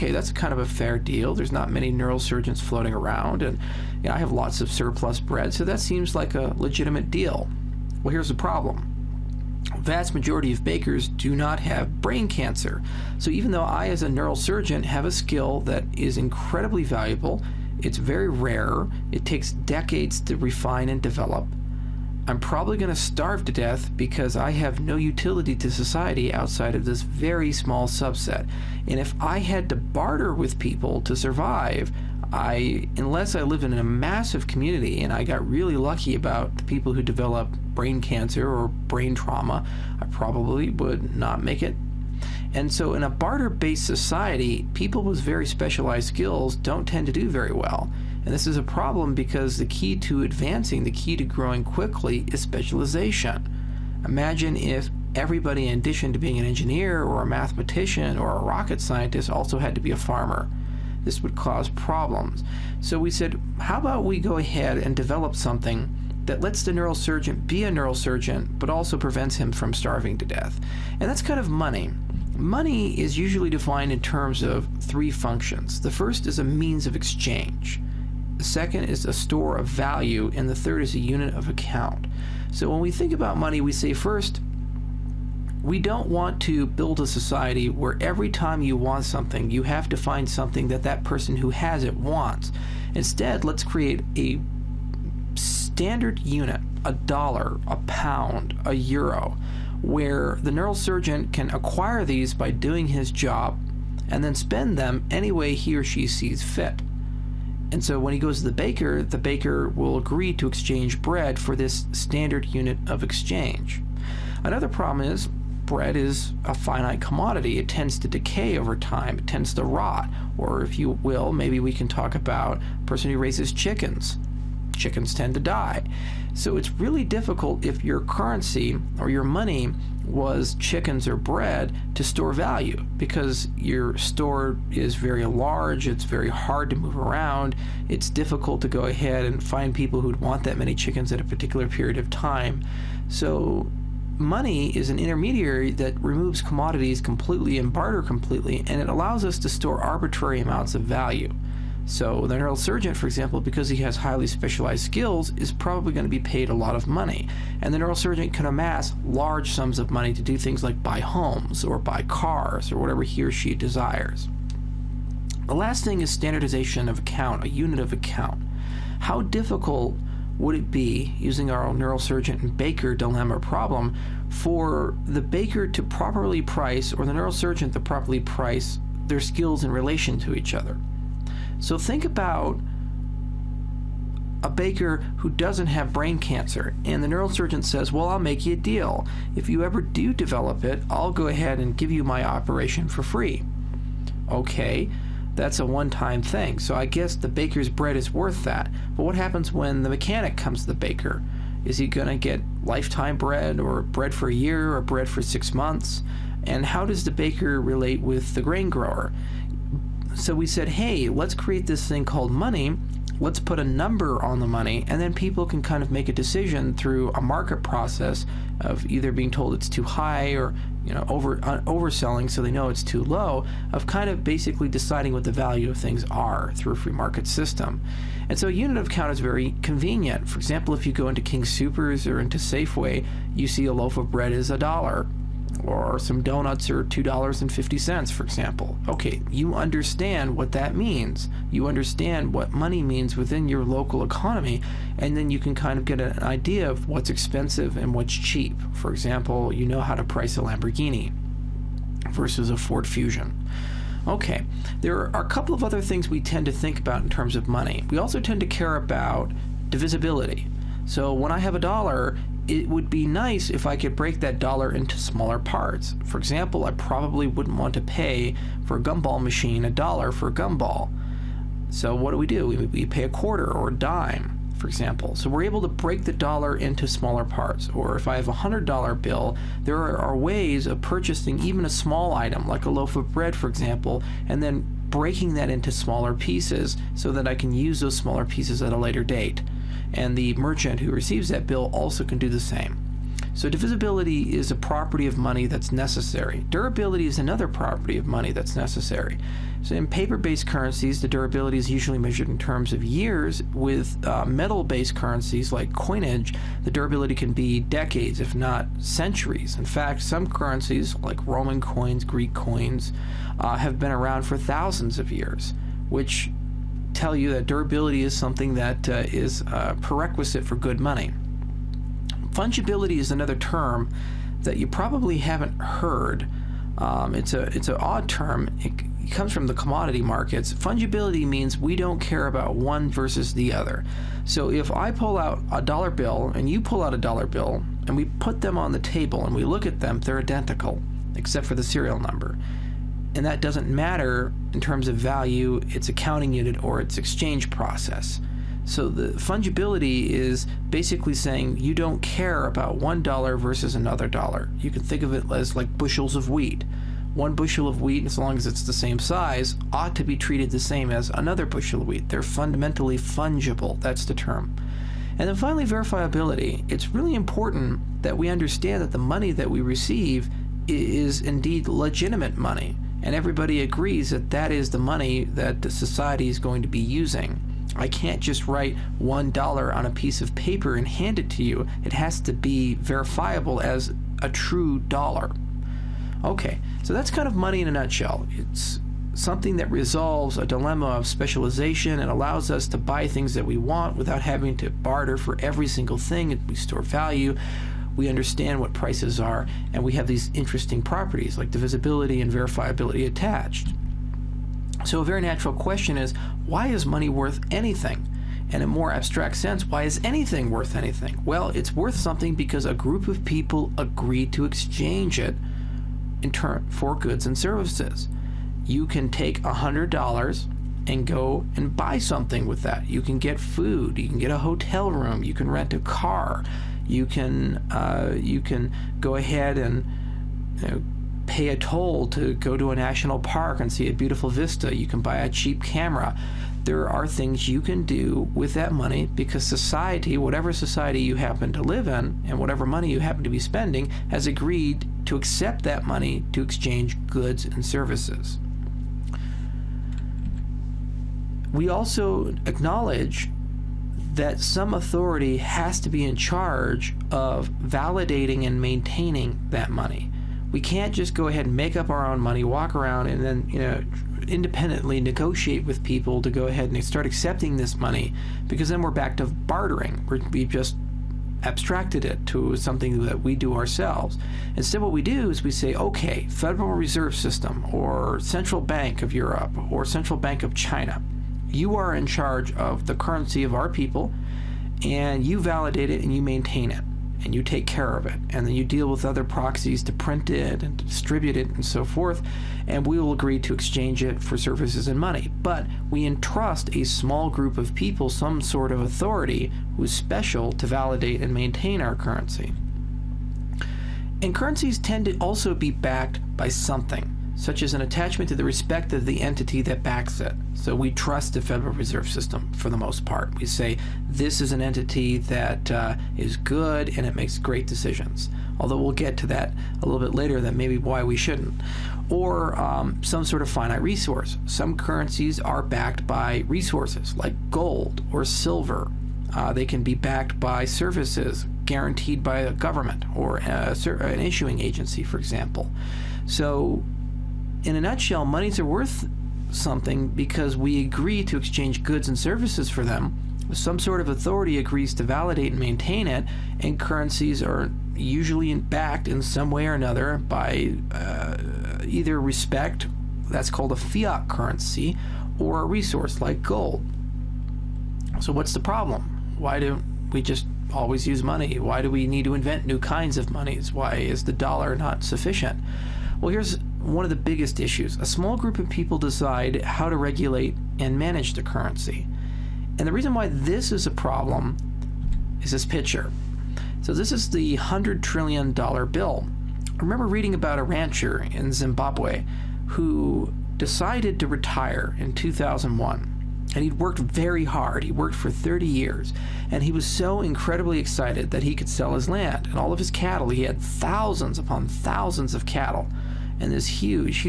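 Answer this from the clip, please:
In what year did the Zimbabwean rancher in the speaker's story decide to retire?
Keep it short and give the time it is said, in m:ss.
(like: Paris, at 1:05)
2001, at 9:45.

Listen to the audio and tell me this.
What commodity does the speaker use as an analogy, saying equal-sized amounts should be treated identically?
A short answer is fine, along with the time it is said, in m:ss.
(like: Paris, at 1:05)
bushels of wheat, at 5:55.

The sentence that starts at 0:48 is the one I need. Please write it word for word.
And this is a problem because the key to advancing, the key to growing quickly, is specialization.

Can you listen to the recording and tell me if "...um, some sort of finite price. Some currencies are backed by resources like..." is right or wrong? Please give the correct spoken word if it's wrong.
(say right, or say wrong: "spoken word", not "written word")
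wrong: "resource", not "price".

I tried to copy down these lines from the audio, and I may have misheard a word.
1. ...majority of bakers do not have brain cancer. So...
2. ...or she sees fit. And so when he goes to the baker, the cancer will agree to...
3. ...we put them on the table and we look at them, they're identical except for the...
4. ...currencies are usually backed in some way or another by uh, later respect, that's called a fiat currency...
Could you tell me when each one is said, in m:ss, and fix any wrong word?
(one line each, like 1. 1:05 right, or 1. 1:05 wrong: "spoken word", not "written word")
1. 0:10 right
2. 1:45 wrong: "baker", not "cancer"
3. 5:37 right
4. 9:06 wrong: "either", not "later".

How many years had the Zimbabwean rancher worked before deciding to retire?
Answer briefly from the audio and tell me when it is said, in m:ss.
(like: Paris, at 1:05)
30 years, at 9:48.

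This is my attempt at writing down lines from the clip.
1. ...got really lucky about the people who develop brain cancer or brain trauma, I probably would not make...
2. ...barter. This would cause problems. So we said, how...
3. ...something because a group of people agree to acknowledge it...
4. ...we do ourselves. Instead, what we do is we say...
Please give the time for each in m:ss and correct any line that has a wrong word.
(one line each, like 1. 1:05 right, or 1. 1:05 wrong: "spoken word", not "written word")
1. 0:35 right
2. 0:59 wrong: "farmer", not "barter"
3. 6:51 wrong: "exchange", not "acknowledge"
4. 7:53 right.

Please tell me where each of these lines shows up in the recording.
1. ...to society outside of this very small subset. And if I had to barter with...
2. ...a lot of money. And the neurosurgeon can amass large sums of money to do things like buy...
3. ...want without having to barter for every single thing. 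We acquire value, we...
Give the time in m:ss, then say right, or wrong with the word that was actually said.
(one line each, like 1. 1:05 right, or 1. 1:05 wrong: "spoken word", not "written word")
1. 0:25 right
2. 2:36 right
3. 6:33 wrong: "store", not "acquire".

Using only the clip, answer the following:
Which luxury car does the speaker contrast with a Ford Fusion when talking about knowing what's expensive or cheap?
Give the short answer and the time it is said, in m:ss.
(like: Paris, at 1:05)
Lamborghini, at 4:10.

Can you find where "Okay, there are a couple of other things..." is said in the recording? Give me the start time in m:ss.
4:14.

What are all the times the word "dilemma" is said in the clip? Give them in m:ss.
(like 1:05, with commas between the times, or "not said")
2:52, 6:30.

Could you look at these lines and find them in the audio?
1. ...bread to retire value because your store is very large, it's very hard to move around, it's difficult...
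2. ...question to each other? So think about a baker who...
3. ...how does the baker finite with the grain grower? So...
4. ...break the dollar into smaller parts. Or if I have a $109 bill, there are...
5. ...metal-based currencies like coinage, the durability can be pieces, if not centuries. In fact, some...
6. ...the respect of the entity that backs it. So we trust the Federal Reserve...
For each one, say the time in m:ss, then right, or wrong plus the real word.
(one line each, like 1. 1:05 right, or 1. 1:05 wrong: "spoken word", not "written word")
1. 2:11 wrong: "store", not "retire"
2. 2:59 wrong: "relation", not "question"
3. 3:26 wrong: "relate", not "finite"
4. 4:35 wrong: "100", not "109"
5. 5:04 wrong: "decades", not "pieces"
6. 8:28 right.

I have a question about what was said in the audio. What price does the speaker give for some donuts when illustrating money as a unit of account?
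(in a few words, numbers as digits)
$2.50.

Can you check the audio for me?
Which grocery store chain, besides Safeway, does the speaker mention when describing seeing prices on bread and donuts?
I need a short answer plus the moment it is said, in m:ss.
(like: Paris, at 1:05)
King Soopers, at 3:51.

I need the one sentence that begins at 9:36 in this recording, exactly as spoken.
So, this is the $100 trillion bill.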